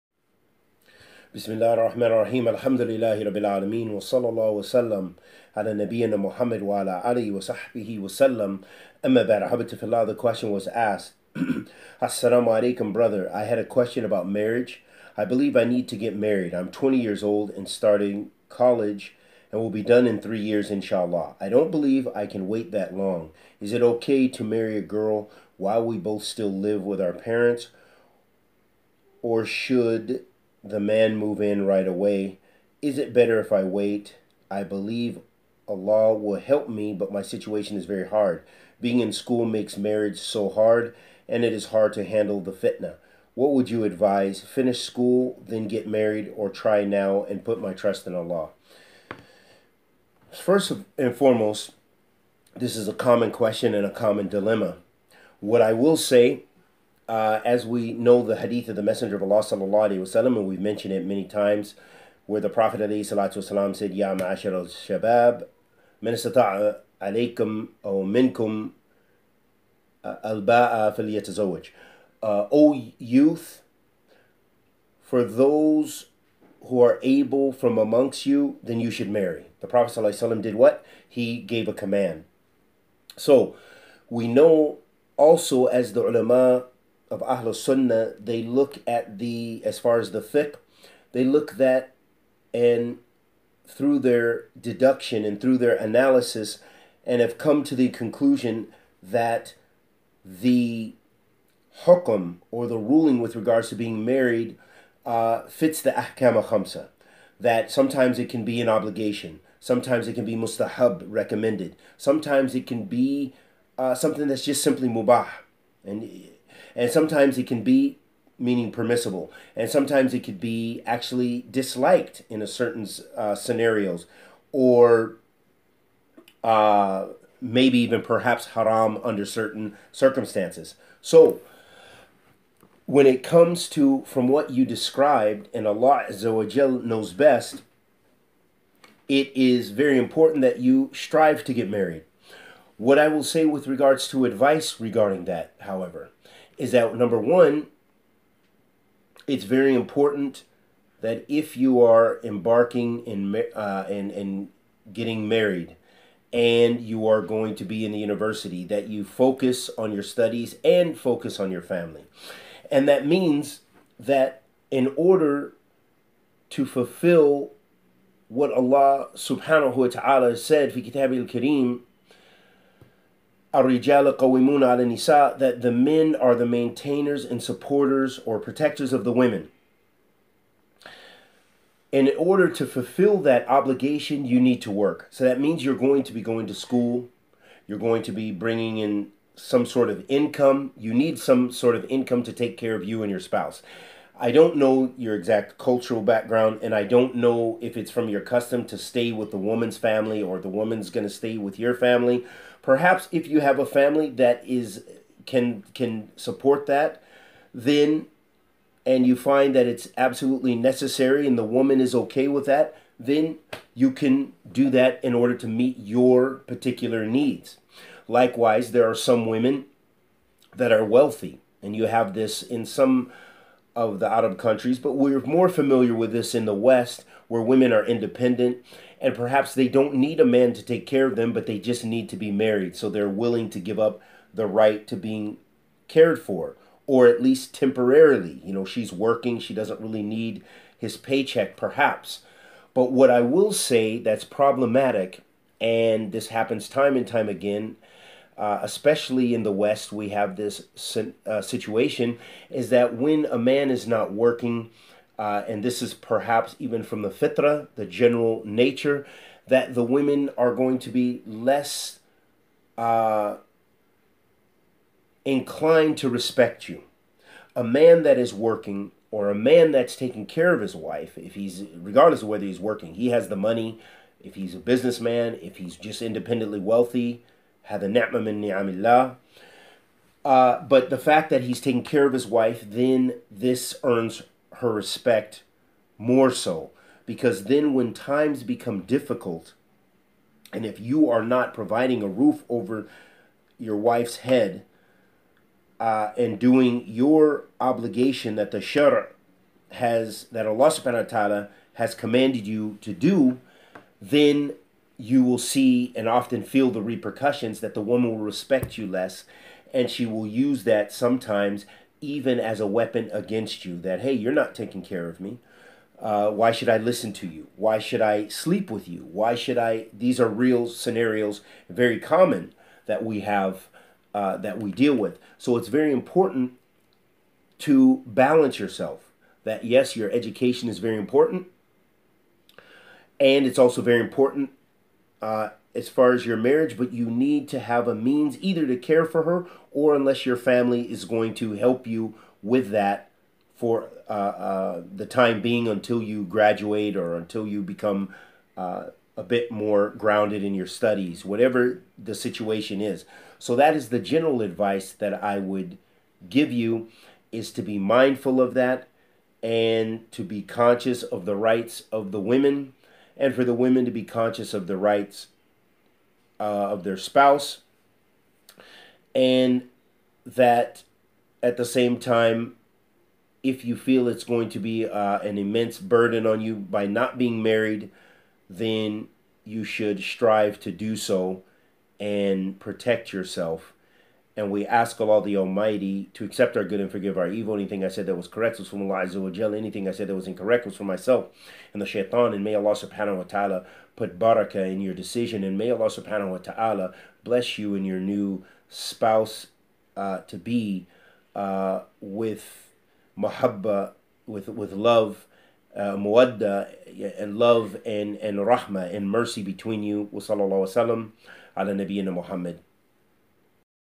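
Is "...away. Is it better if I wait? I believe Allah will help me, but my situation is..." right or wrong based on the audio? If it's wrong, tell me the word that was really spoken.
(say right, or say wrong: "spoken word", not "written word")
right.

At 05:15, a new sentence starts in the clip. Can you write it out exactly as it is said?
Uh, why should I listen to you?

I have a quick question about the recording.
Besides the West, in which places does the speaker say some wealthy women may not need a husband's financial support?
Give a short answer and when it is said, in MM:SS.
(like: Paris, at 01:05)
Arab countries, at 03:44.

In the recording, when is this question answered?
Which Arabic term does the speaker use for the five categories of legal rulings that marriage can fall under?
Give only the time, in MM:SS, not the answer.
01:45.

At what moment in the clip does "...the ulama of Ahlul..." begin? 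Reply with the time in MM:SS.
01:25.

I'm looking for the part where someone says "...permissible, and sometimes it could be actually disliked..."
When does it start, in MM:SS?
01:58.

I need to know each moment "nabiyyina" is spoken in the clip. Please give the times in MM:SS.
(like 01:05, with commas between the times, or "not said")
00:05, 06:51.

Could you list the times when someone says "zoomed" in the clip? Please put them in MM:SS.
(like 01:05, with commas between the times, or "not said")
not said.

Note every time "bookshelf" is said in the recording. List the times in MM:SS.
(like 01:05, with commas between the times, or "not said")
not said.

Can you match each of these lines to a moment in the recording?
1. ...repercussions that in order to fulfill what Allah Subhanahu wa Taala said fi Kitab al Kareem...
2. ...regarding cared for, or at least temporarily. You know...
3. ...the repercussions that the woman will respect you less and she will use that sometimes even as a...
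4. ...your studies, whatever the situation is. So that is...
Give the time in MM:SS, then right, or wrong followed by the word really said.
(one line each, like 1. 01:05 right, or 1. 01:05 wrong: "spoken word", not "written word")
1. 02:43 wrong: "means", not "repercussions"
2. 03:54 wrong: "being", not "regarding"
3. 05:06 right
4. 05:50 right.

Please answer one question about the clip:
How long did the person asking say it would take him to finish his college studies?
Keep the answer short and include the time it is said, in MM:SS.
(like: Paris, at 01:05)
3 years, at 00:20.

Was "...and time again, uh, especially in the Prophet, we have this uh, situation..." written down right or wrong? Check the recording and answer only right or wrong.
wrong.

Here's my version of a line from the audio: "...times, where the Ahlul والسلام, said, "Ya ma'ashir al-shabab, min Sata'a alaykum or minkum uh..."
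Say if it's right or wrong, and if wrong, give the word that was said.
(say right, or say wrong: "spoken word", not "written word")
wrong: "Prophet", not "Ahlul".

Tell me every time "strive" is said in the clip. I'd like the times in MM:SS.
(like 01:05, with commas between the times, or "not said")
02:20, 06:20.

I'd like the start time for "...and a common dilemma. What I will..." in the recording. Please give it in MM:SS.
00:53.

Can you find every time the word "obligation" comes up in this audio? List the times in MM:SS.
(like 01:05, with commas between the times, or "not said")
01:48, 03:03, 04:57.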